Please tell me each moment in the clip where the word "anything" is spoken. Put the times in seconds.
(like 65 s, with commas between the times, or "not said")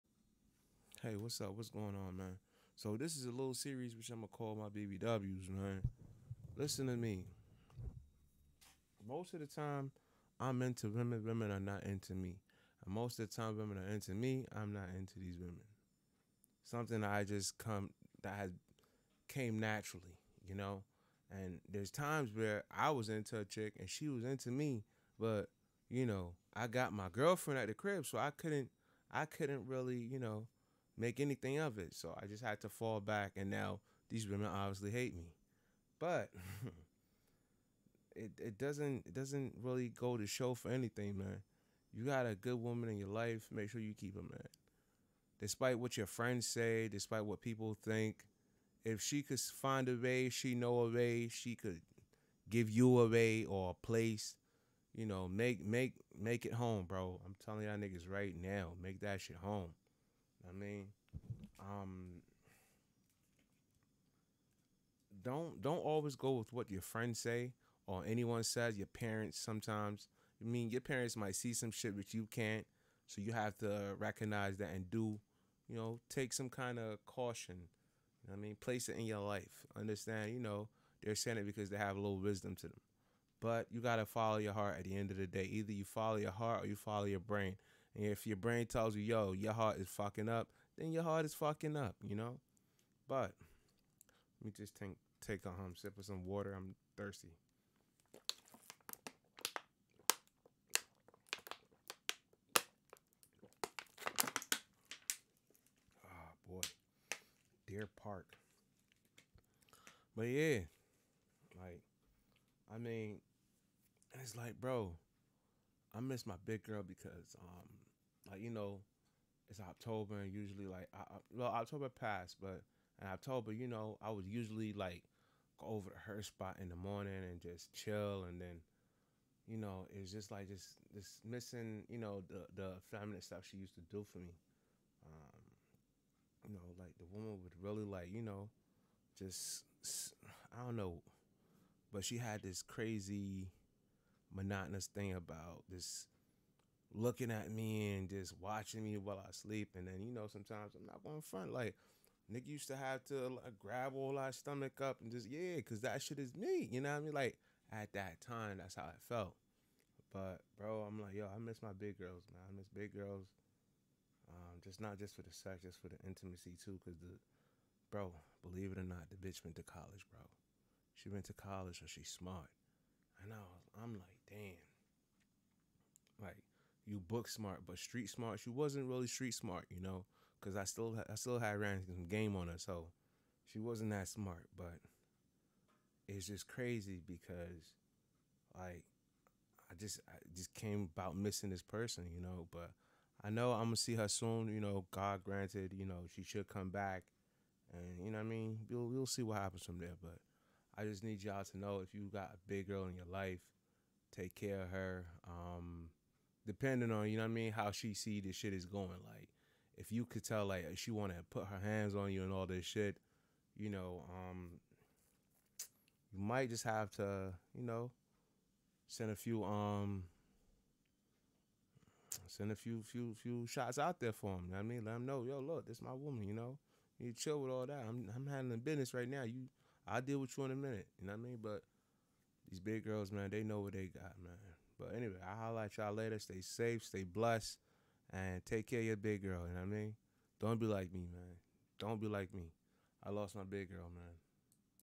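31 s, 40 s.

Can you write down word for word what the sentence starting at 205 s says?
Um, depending on you know what I mean, how she see this shit is going.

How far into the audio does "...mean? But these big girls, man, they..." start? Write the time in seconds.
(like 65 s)
231 s.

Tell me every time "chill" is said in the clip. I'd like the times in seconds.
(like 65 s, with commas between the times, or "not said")
127 s, 227 s.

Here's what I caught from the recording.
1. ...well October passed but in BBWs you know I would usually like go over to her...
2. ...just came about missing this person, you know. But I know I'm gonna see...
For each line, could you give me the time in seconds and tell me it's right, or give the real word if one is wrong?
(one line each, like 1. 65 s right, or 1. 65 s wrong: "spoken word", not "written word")
1. 121 s wrong: "October", not "BBWs"
2. 190 s right.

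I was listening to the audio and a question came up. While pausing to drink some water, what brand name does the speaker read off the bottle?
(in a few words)
Deer Park.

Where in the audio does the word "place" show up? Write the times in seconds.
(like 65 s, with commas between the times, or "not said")
53 s, 78 s.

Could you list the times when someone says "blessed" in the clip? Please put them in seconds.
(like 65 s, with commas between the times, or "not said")
237 s.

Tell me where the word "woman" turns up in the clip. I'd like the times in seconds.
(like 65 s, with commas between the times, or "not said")
42 s, 137 s, 225 s.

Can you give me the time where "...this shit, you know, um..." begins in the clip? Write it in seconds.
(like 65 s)
212 s.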